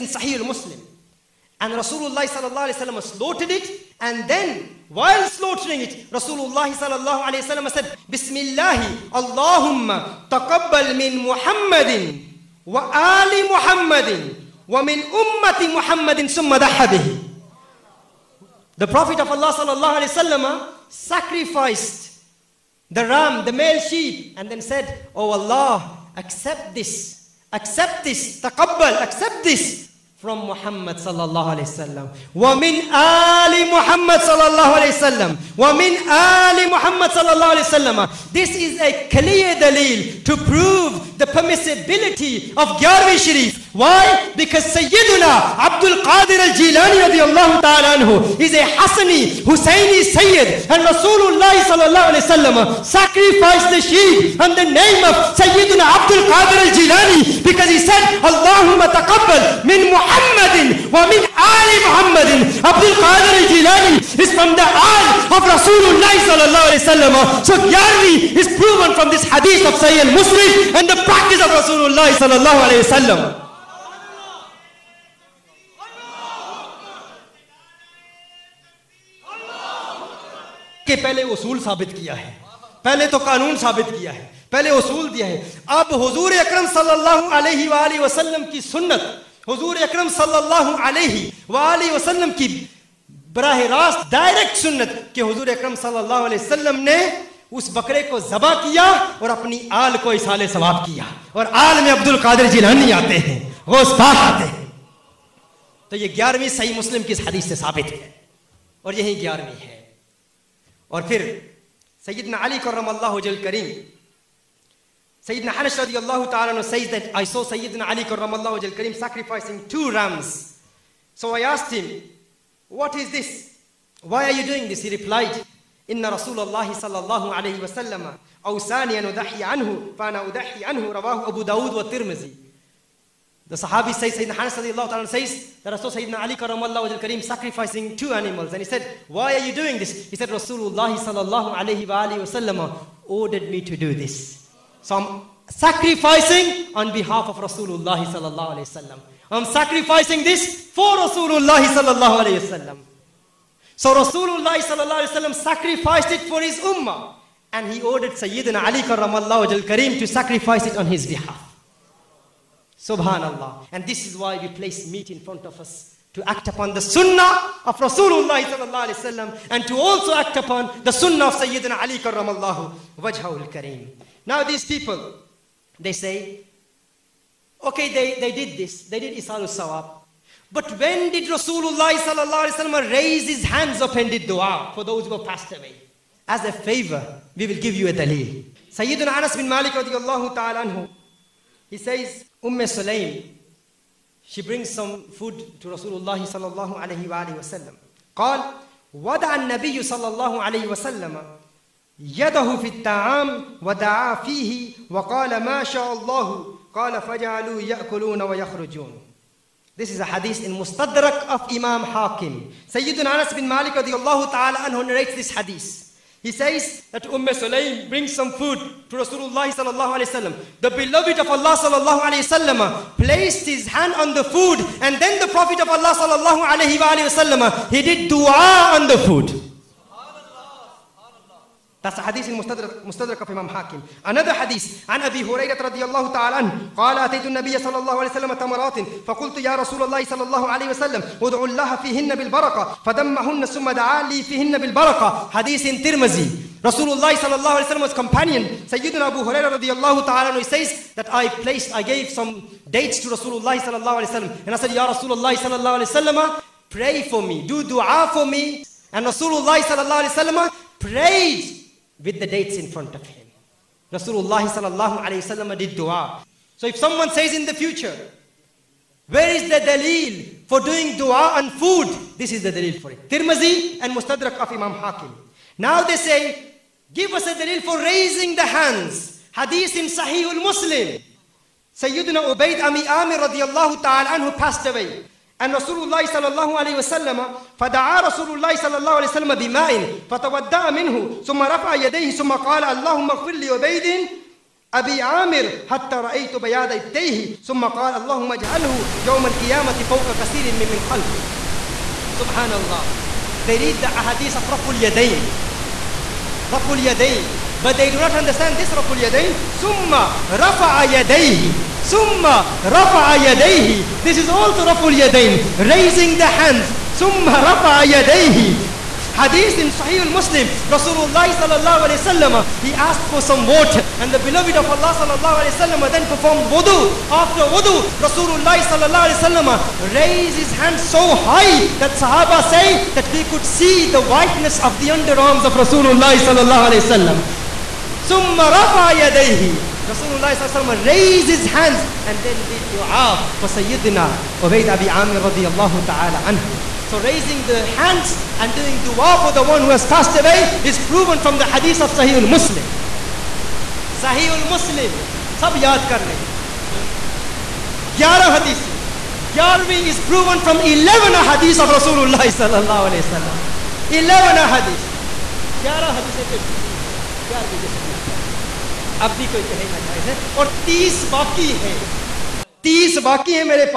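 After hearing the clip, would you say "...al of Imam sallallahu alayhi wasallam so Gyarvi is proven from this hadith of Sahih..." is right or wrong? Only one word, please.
wrong.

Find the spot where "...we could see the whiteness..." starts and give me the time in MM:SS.
05:33.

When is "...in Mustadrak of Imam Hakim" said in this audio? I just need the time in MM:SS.
03:30.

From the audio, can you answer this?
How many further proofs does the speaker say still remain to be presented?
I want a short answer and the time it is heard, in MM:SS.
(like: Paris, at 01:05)
30, at 06:10.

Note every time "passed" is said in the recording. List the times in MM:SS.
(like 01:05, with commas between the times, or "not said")
03:05, 04:44, 05:49.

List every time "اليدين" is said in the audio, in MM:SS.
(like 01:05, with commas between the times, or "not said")
05:04.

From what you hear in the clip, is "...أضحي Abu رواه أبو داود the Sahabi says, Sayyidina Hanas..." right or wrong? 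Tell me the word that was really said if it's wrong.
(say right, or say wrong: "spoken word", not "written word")
right.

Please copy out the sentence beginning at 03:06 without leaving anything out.
As a favor, we will give you a dalil.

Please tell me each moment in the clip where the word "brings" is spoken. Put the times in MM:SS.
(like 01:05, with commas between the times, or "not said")
03:14, 03:37.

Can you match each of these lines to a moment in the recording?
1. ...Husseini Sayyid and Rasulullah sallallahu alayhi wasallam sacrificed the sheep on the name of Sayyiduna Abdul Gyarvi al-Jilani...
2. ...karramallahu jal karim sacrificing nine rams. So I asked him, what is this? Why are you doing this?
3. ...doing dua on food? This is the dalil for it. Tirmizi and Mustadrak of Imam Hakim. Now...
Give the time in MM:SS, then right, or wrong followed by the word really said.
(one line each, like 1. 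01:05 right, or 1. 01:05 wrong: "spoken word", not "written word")
1. 00:49 wrong: "Qadir", not "Gyarvi"
2. 01:58 wrong: "two", not "nine"
3. 04:30 right.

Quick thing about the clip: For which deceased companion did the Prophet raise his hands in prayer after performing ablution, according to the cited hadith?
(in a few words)
Ubaid Abi Amir.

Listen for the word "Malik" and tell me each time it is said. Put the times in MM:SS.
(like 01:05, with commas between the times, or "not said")
03:09, 03:33.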